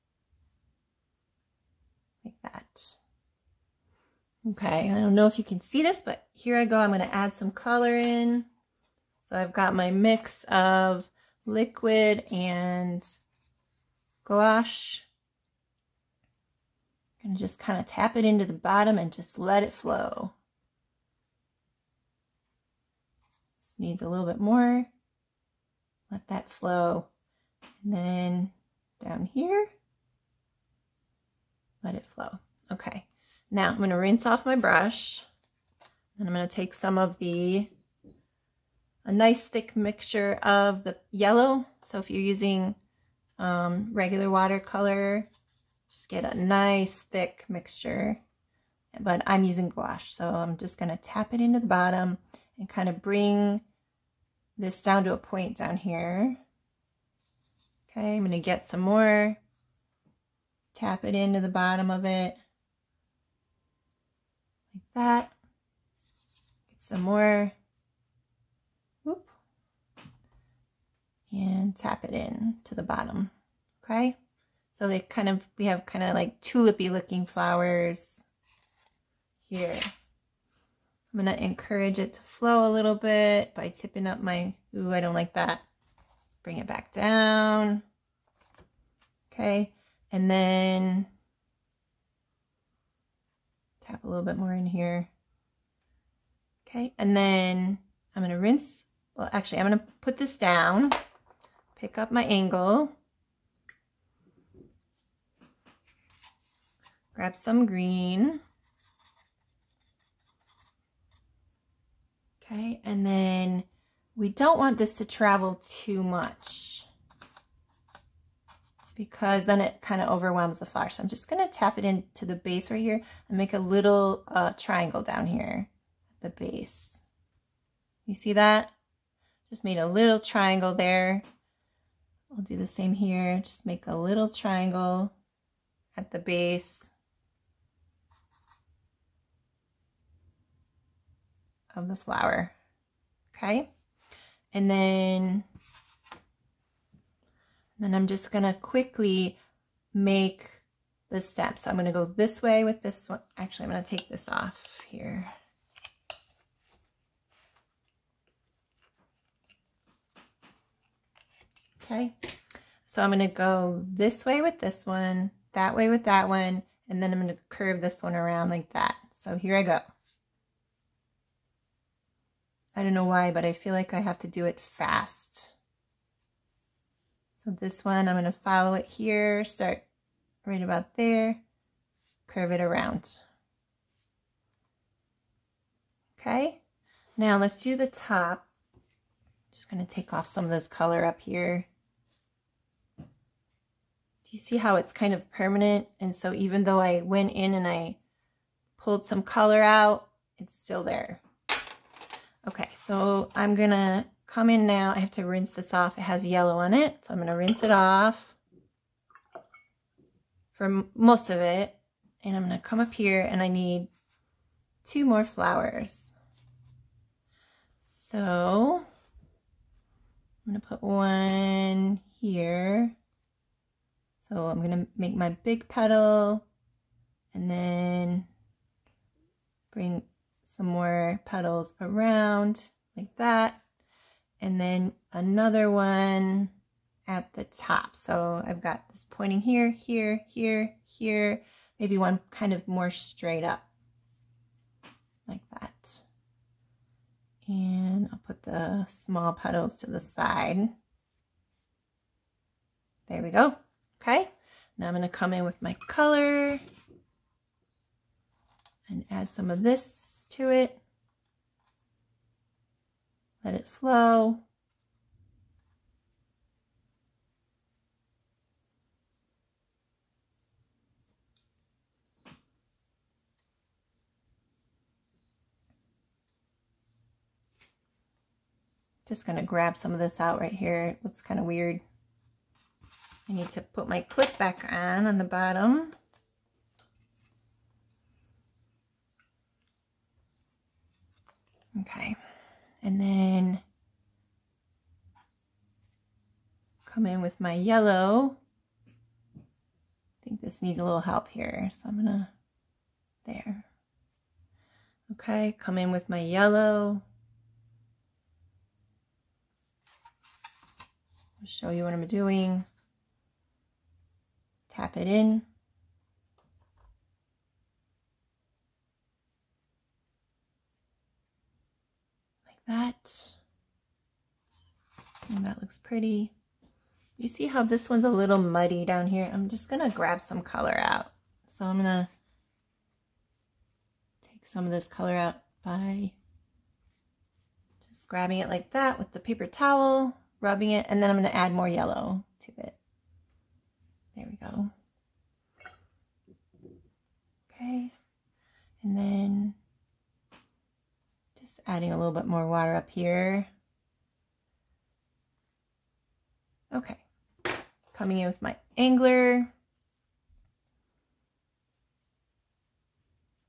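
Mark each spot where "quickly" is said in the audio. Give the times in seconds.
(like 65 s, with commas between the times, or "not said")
148 s.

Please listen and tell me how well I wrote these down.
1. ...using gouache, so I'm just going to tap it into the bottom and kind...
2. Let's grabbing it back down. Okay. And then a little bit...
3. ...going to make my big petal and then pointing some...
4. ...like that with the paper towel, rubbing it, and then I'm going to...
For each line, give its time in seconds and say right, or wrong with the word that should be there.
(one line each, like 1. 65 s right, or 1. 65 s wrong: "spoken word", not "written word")
1. 49 s right
2. 86 s wrong: "bring", not "grabbing"
3. 224 s wrong: "bring", not "pointing"
4. 338 s right.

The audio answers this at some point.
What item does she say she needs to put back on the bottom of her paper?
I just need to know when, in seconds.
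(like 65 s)
284 s.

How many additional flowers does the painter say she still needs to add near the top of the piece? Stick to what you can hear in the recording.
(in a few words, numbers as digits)
2.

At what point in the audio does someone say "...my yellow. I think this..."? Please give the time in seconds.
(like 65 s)
297 s.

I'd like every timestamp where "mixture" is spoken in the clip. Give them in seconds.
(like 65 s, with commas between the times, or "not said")
39 s, 47 s.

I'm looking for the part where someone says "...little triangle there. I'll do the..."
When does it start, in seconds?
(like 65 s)
129 s.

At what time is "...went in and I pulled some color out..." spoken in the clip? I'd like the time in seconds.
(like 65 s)
197 s.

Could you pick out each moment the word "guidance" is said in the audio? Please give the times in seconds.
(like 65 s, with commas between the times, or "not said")
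not said.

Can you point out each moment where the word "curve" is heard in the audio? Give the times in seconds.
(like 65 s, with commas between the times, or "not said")
167 s, 182 s.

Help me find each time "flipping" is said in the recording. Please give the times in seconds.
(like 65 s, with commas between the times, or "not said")
not said.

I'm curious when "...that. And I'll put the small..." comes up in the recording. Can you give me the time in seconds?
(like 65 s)
245 s.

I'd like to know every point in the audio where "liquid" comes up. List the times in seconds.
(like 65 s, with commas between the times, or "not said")
11 s.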